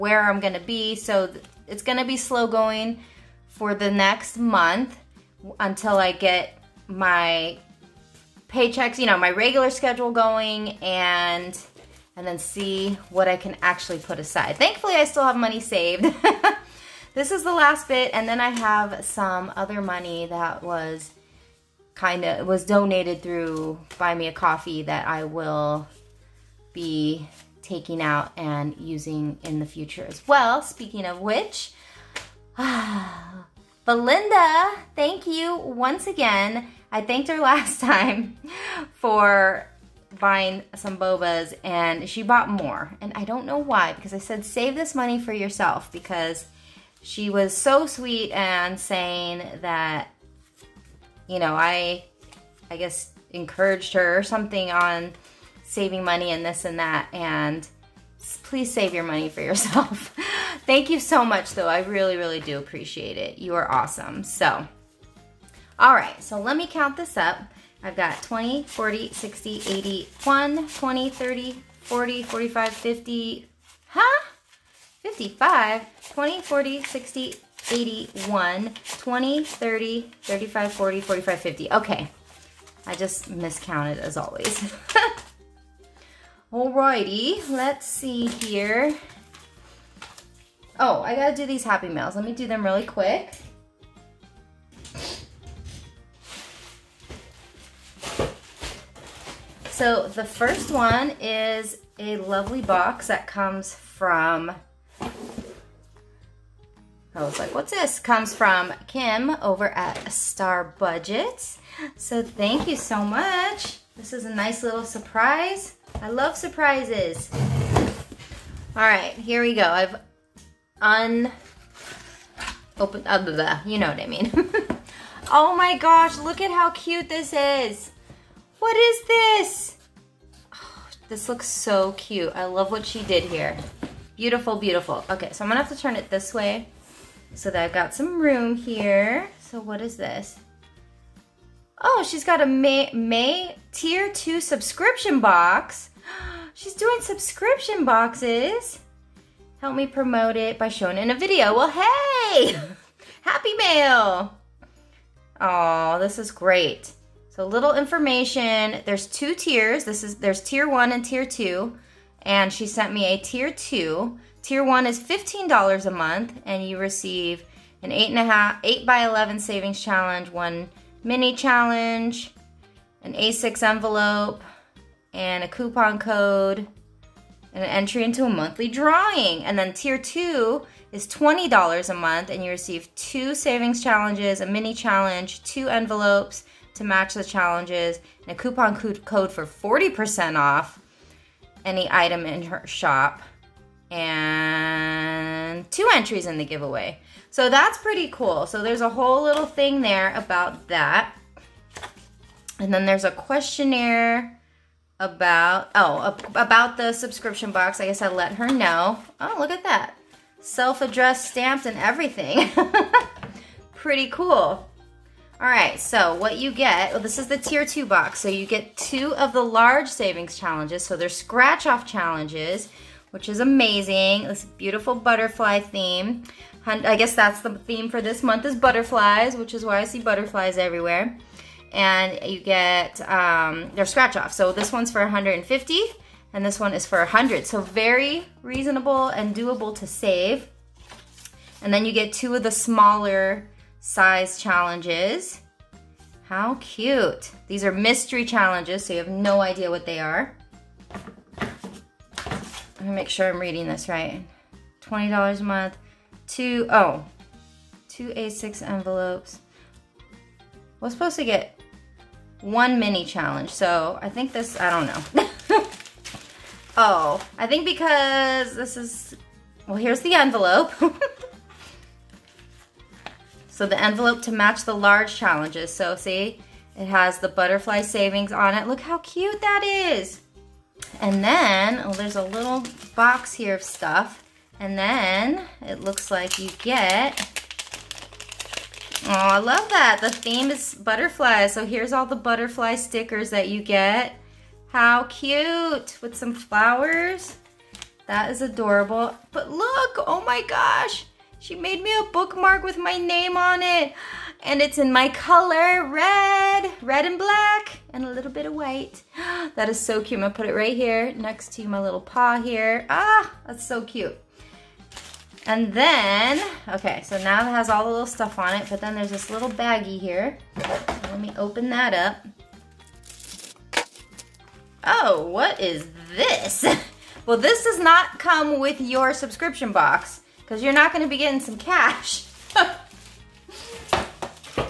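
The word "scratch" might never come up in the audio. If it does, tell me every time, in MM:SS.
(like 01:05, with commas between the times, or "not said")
03:41, 03:53.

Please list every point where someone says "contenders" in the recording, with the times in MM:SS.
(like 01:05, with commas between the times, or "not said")
not said.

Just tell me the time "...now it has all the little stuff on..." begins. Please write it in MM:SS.
05:17.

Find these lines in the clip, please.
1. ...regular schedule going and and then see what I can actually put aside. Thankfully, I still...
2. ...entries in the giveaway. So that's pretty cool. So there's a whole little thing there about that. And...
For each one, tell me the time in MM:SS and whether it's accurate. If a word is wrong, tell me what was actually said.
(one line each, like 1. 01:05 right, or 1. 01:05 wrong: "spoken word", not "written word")
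1. 00:09 right
2. 03:15 right.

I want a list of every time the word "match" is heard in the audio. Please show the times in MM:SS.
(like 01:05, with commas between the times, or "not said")
03:06, 04:34.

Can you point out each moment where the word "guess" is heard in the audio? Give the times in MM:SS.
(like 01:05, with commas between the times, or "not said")
00:52, 03:27, 03:46.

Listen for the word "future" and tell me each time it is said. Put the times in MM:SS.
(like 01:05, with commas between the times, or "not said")
00:29.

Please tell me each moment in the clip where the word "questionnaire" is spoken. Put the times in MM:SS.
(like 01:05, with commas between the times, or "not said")
03:23.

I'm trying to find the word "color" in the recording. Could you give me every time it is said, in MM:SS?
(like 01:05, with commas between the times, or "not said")
05:05.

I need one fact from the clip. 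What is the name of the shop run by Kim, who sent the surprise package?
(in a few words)
Star Budget.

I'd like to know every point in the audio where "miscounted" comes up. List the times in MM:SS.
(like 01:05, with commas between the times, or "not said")
01:23.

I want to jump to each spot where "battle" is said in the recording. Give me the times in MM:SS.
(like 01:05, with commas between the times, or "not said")
not said.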